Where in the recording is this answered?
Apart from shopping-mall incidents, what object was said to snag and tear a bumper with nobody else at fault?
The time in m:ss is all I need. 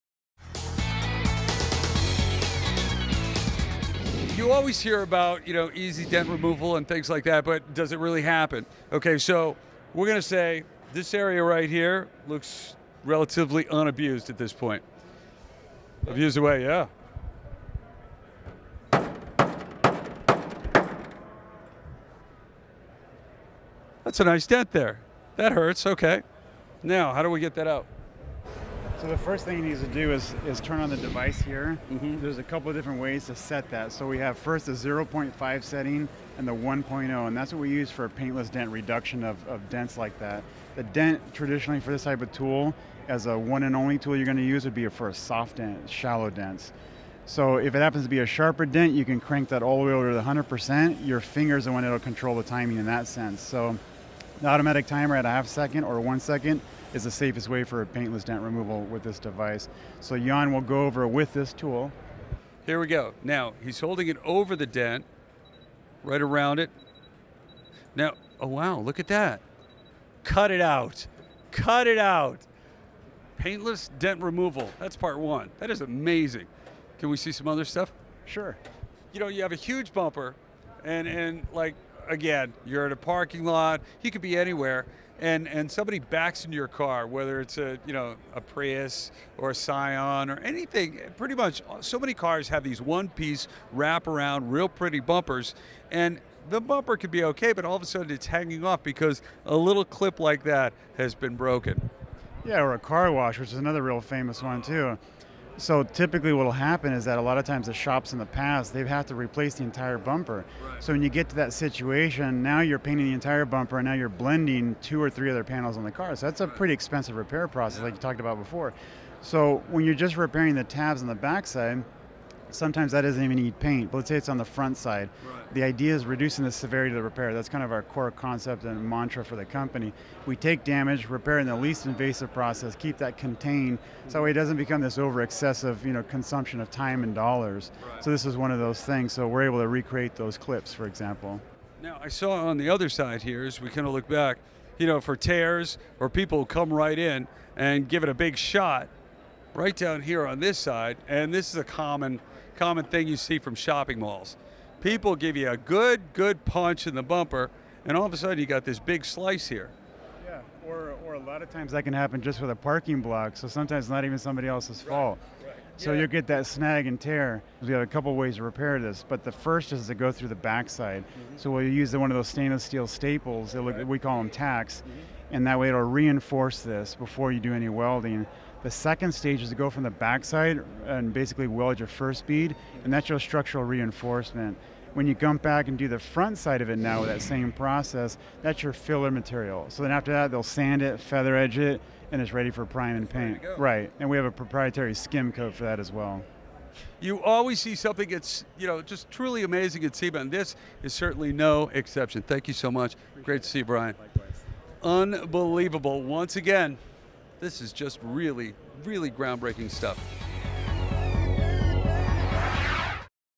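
2:42.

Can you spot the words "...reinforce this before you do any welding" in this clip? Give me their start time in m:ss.
2:55.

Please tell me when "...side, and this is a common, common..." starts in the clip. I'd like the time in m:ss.
2:30.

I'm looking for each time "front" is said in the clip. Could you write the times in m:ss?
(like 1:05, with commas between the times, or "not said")
2:04, 3:05.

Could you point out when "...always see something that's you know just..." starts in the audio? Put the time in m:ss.
3:17.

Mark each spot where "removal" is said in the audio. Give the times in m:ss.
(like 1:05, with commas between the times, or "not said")
0:06, 0:58, 1:14.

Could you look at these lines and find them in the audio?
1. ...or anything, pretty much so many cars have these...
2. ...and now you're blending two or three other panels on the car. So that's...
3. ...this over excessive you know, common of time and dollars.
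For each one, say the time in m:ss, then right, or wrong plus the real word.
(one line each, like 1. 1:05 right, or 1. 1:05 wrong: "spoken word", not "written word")
1. 1:30 right
2. 1:53 right
3. 2:14 wrong: "consumption", not "common".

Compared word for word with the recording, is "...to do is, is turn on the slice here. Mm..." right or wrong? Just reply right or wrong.
wrong.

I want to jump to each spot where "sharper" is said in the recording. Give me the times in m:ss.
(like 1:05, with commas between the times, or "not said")
0:48.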